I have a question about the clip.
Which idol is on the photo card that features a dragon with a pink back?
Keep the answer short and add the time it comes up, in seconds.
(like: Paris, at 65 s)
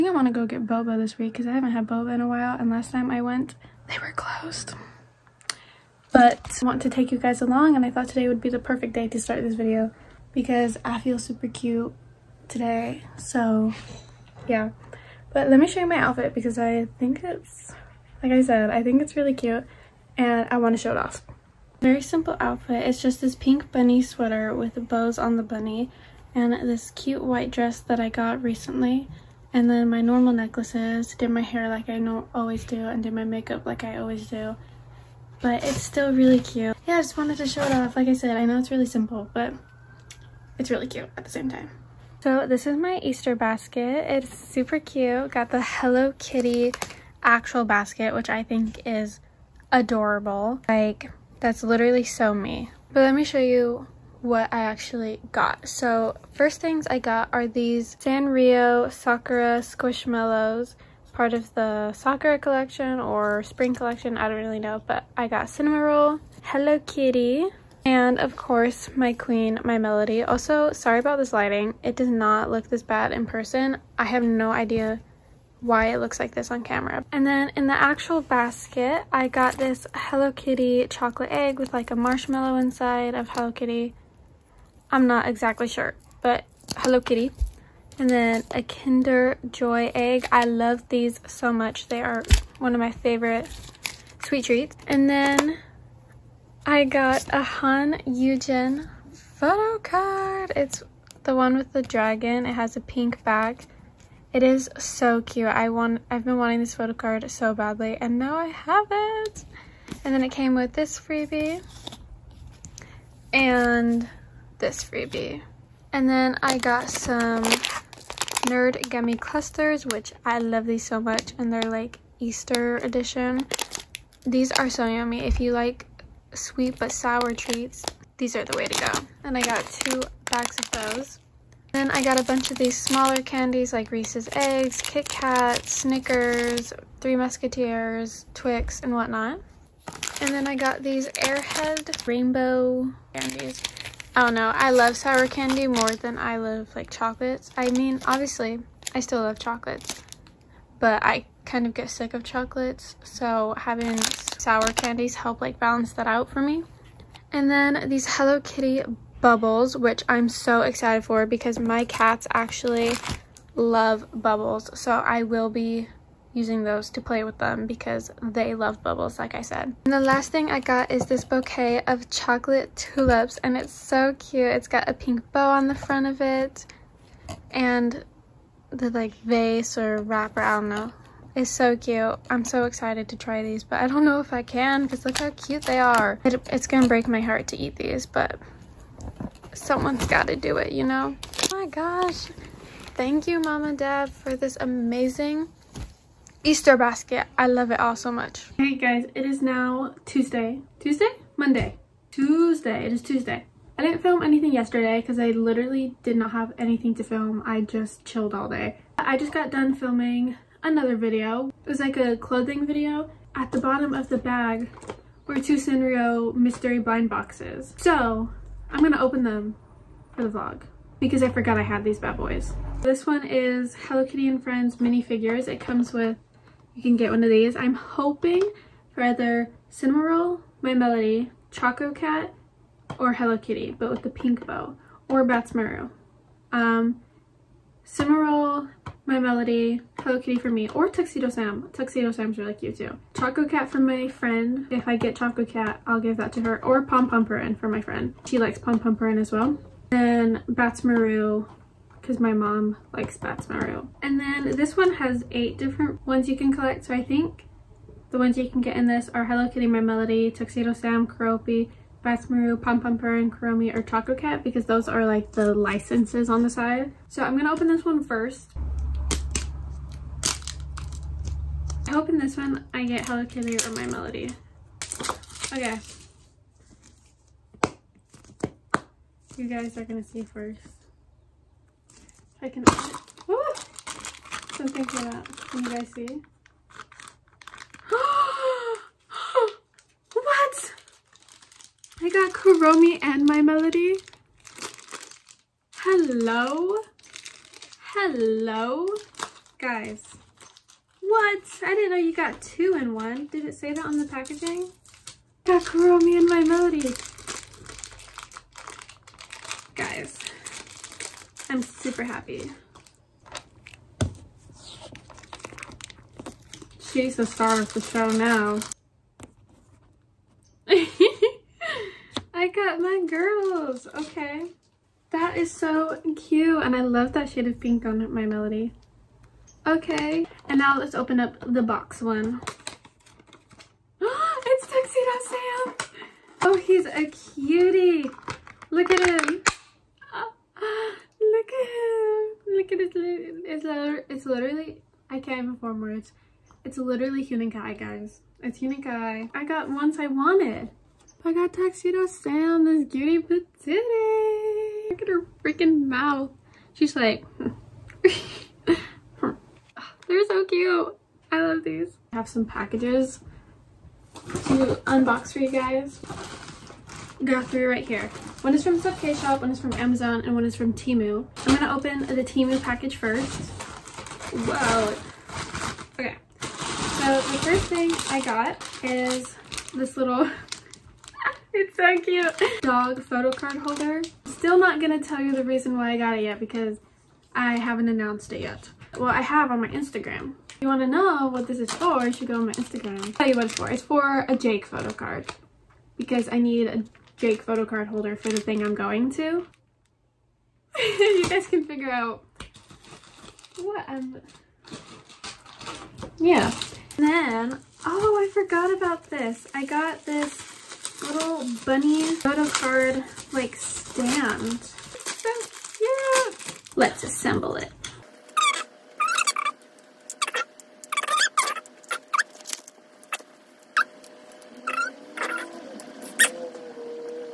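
Han Yujin, at 97 s.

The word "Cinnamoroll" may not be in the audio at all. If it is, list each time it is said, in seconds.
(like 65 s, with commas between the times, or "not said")
65 s, 229 s, 237 s.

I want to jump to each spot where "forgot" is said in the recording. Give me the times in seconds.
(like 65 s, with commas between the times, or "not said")
221 s, 408 s.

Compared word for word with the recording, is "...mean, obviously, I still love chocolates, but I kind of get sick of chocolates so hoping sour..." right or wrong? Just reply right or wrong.
wrong.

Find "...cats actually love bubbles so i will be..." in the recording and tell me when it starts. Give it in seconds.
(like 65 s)
161 s.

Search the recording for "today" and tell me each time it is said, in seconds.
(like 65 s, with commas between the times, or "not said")
8 s, 12 s.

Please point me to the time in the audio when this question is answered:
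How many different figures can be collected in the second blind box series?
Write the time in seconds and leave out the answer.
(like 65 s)
255 s.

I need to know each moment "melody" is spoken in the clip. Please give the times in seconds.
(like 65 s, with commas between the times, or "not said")
69 s, 230 s, 239 s, 259 s, 273 s, 293 s, 306 s, 328 s.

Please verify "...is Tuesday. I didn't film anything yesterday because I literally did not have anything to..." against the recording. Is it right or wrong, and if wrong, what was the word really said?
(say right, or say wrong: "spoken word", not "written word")
right.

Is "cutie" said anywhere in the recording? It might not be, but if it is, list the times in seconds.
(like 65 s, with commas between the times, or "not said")
337 s, 352 s.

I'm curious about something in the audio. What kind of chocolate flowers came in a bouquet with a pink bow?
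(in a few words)
Tulips.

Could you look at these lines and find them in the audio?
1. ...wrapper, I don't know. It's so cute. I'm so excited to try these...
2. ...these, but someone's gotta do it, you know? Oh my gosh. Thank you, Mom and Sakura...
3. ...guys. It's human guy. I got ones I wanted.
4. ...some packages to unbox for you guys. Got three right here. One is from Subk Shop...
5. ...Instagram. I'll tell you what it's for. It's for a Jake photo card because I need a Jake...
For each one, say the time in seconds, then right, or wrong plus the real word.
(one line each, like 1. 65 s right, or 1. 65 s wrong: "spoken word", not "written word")
1. 180 s right
2. 187 s wrong: "Dad", not "Sakura"
3. 347 s right
4. 362 s right
5. 392 s right.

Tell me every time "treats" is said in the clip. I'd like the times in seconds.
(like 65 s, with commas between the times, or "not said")
94 s, 127 s.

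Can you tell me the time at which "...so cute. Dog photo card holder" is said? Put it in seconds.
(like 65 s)
381 s.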